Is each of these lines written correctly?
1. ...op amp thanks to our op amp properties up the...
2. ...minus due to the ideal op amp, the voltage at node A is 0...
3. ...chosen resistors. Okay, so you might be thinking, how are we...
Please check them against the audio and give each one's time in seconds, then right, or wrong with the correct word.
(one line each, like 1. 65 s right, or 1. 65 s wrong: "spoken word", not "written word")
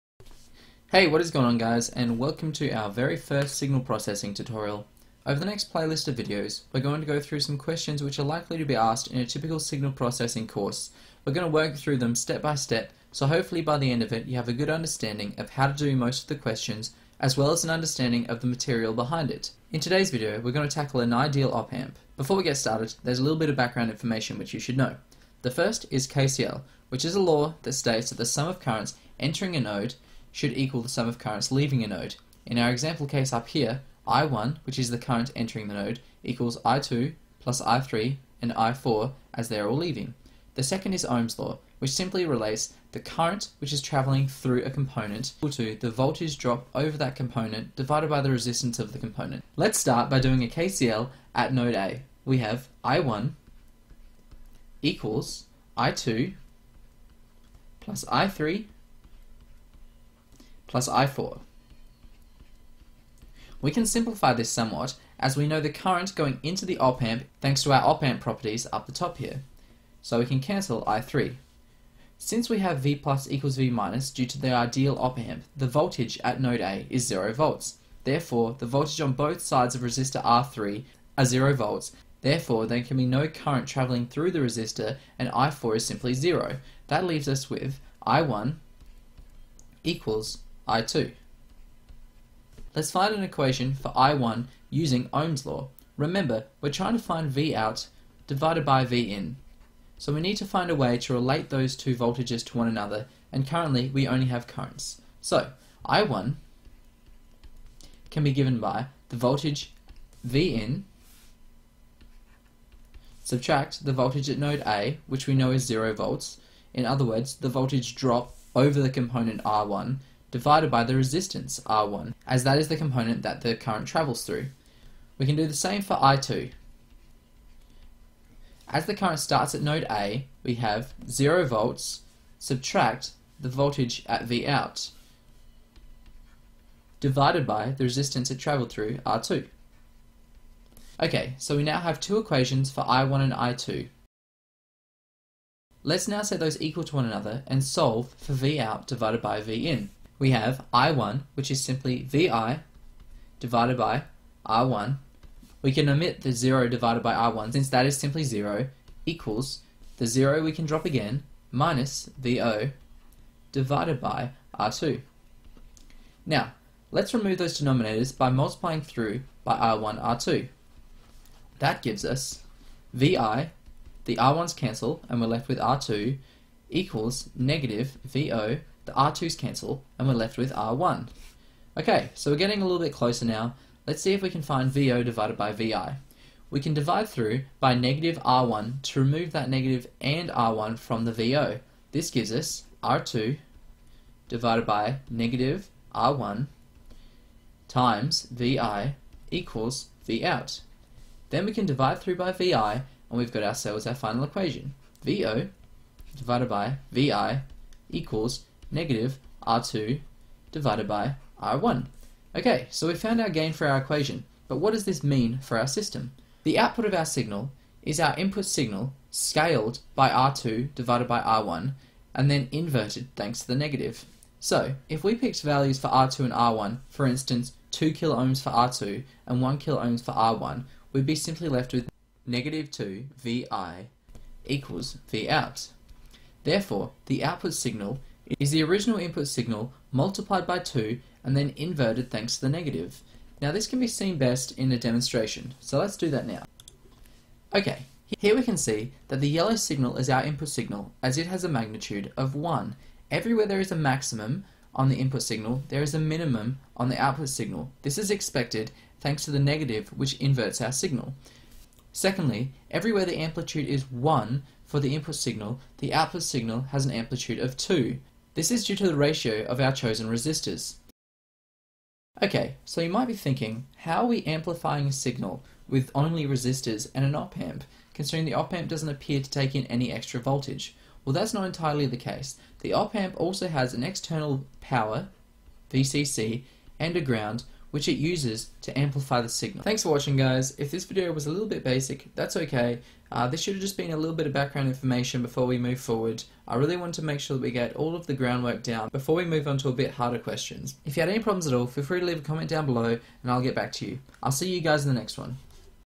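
1. 66 s right
2. 73 s right
3. 269 s right.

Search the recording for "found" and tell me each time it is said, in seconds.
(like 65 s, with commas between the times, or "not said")
212 s.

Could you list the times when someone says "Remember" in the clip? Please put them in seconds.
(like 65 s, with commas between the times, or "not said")
95 s.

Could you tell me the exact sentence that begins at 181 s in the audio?
Okay, so we're getting a little bit closer now.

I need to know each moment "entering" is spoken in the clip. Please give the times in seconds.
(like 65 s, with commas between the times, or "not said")
29 s, 35 s.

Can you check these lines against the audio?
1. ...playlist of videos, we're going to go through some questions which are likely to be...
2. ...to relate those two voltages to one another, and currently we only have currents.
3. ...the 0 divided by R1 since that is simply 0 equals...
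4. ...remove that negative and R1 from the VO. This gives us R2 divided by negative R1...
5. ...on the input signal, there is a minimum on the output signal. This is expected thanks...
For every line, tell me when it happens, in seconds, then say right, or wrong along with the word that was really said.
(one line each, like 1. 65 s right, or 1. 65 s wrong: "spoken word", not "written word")
1. 5 s right
2. 100 s right
3. 156 s right
4. 188 s right
5. 254 s right.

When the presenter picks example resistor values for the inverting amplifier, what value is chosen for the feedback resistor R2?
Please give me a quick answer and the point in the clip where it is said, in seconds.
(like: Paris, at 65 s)
2 kilo ohms, at 227 s.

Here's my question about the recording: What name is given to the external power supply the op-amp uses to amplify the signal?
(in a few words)
VCC.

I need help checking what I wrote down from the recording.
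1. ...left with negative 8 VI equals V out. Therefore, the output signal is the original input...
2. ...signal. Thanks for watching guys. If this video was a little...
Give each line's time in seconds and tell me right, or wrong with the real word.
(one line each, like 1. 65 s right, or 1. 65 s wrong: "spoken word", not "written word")
1. 231 s wrong: "2", not "8"
2. 289 s right.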